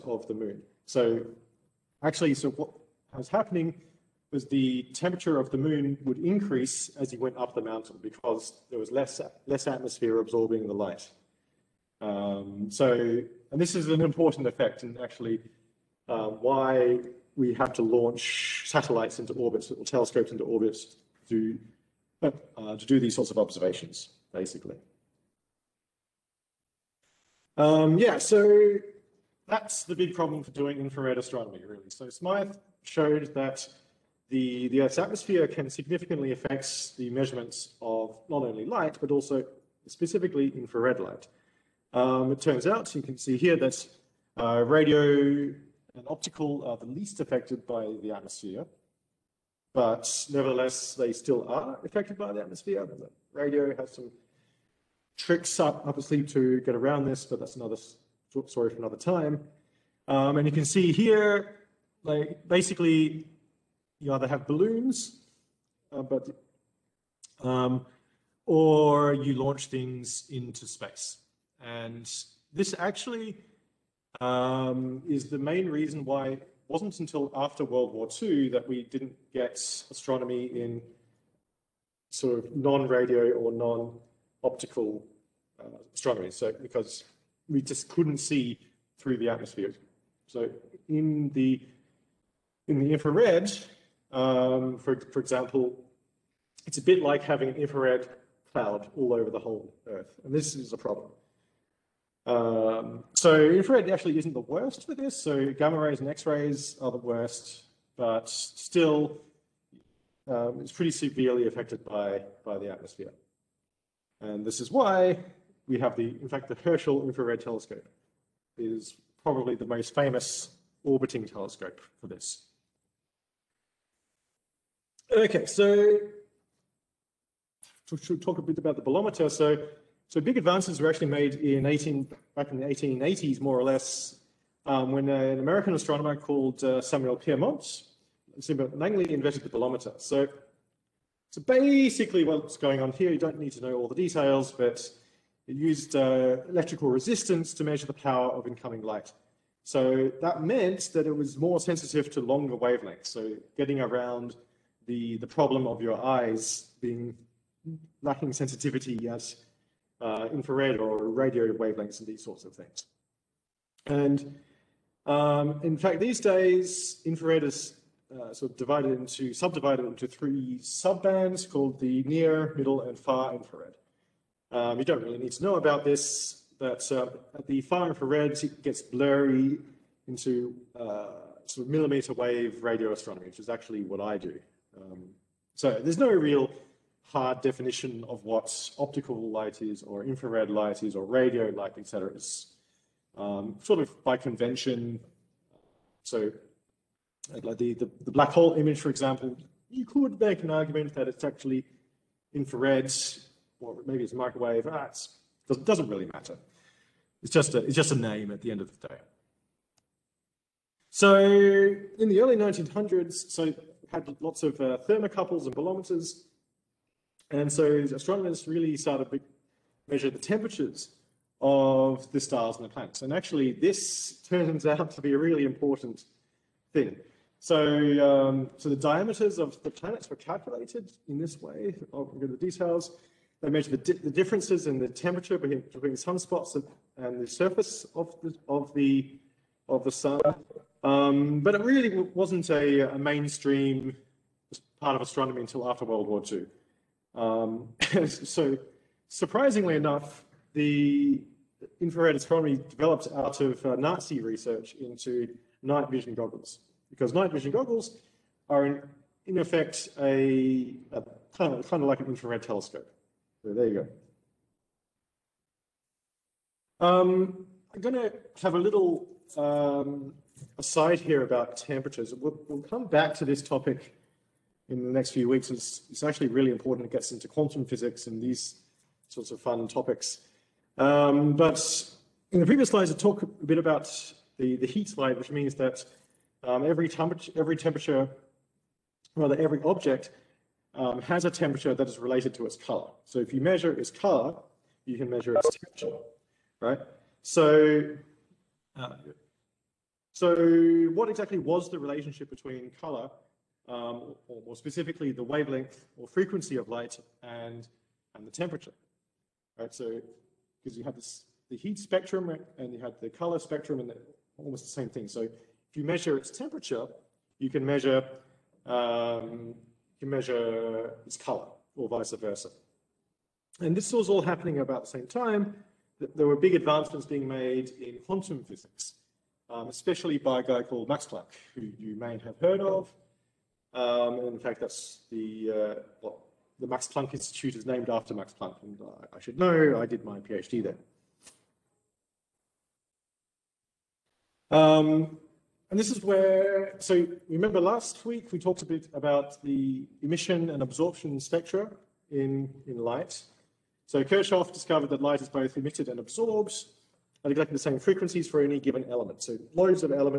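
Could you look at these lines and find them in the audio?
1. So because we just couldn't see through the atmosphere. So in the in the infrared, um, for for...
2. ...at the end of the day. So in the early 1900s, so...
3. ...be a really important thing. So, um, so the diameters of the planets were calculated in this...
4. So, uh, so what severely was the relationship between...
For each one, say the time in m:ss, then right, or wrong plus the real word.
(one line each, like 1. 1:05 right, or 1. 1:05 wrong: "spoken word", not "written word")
1. 1:26 right
2. 3:28 right
3. 3:45 right
4. 4:57 wrong: "exactly", not "severely".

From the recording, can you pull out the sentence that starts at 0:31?
So Smyth showed that the, the Earth's atmosphere can significantly affect the measurements of not only light, but also specifically infrared light.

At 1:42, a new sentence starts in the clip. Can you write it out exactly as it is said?
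Um, so infrared actually isn't the worst for this.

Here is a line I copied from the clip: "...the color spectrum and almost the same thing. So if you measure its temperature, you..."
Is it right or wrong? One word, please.
right.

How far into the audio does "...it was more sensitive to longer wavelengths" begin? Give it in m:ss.
2:31.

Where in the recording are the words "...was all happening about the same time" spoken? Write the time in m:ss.
5:23.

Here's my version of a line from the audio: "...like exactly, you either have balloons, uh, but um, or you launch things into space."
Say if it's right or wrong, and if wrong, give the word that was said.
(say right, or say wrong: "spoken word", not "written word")
wrong: "basically", not "exactly".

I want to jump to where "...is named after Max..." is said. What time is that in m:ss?
5:37.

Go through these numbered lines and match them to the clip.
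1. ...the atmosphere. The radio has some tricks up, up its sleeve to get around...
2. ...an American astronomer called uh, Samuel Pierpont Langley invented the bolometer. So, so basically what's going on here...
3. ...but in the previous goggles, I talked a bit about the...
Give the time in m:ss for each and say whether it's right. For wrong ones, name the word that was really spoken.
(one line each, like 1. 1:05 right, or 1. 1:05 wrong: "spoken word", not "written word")
1. 0:52 right
2. 2:15 right
3. 4:41 wrong: "slides", not "goggles".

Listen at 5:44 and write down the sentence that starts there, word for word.
Um, and this is where, so remember last week we talked a bit about the emission and absorption spectra in, in light.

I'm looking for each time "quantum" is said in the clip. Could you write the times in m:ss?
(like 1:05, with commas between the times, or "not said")
4:37, 5:28.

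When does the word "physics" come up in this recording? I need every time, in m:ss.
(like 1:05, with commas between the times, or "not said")
4:37, 5:28.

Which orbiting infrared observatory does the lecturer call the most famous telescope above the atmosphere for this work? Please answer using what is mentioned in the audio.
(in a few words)
Herschel Infrared Telescope.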